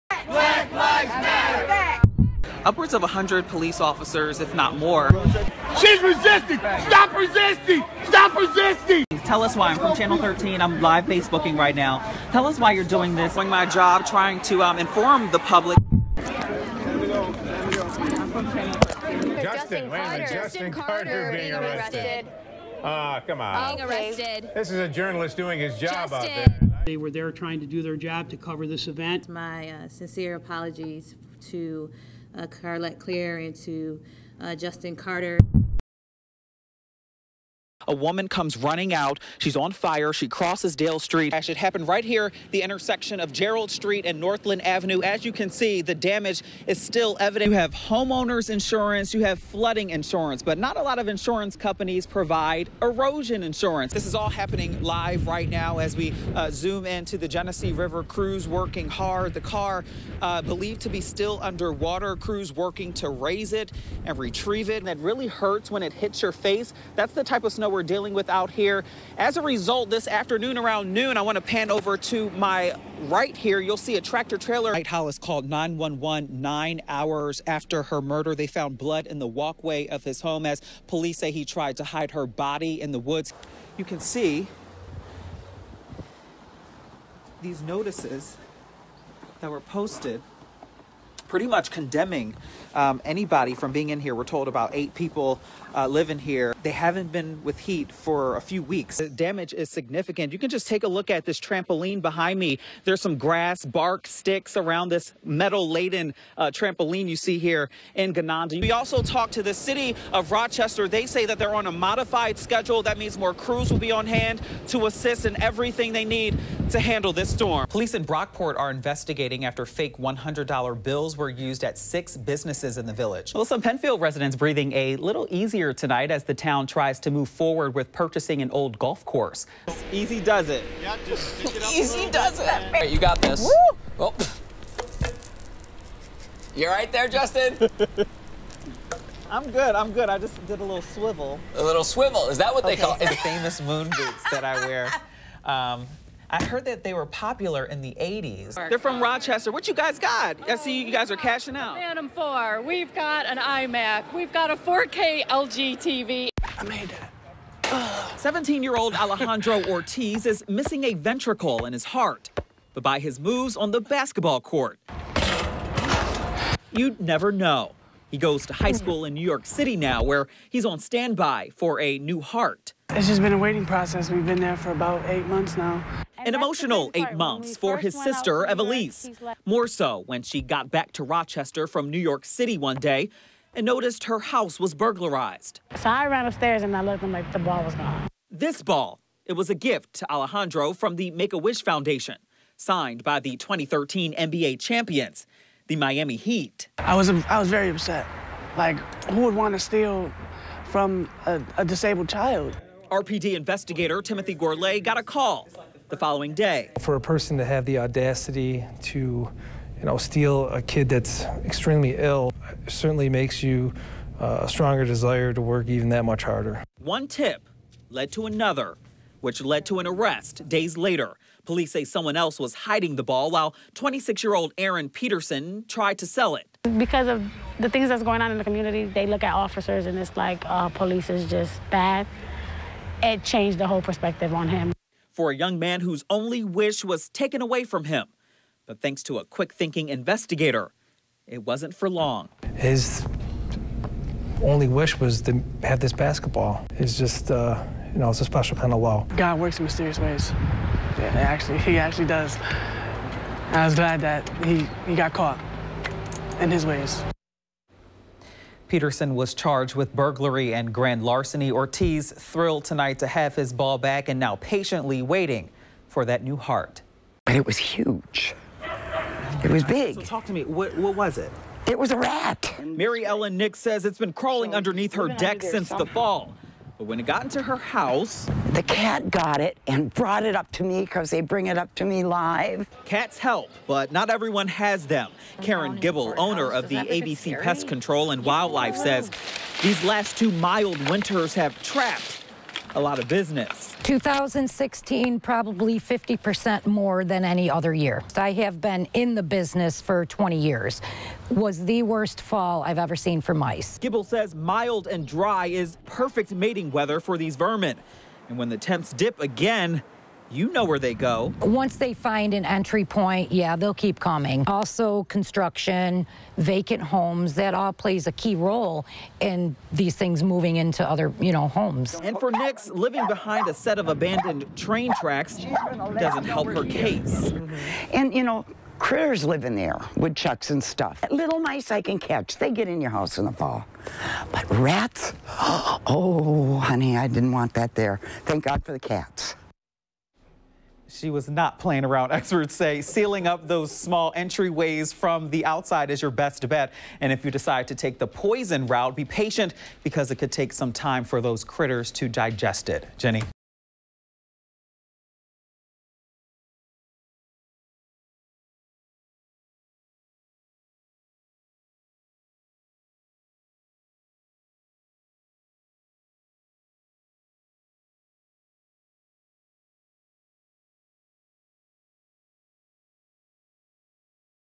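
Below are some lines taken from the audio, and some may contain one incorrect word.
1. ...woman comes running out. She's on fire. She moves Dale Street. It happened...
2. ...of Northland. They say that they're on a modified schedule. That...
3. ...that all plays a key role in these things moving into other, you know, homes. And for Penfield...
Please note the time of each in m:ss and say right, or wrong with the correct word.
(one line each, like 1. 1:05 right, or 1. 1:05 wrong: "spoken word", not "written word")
1. 0:37 wrong: "crosses", not "moves"
2. 1:50 wrong: "Rochester", not "Northland"
3. 5:17 wrong: "Nix", not "Penfield".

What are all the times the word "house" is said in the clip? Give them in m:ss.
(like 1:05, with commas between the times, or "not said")
3:04, 4:37, 5:32.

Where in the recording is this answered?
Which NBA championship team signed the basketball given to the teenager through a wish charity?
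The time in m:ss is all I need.
3:15.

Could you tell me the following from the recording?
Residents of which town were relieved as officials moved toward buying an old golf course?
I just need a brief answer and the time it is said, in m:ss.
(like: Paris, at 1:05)
Penfield, at 2:03.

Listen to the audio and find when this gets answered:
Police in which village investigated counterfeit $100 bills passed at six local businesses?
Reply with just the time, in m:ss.
1:58.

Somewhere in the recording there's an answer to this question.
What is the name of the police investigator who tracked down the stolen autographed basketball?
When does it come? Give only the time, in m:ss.
3:24.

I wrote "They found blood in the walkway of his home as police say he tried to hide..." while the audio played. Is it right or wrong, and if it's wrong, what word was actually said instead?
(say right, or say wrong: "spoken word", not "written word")
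right.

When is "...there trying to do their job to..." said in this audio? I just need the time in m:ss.
0:27.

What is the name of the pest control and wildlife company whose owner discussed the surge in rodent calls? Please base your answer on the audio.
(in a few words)
ABC Pest Control and Wildlife.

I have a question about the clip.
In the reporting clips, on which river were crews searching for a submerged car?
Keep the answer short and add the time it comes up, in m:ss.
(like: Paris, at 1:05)
Genesee River, at 0:57.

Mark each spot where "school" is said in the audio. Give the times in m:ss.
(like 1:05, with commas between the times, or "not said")
2:48.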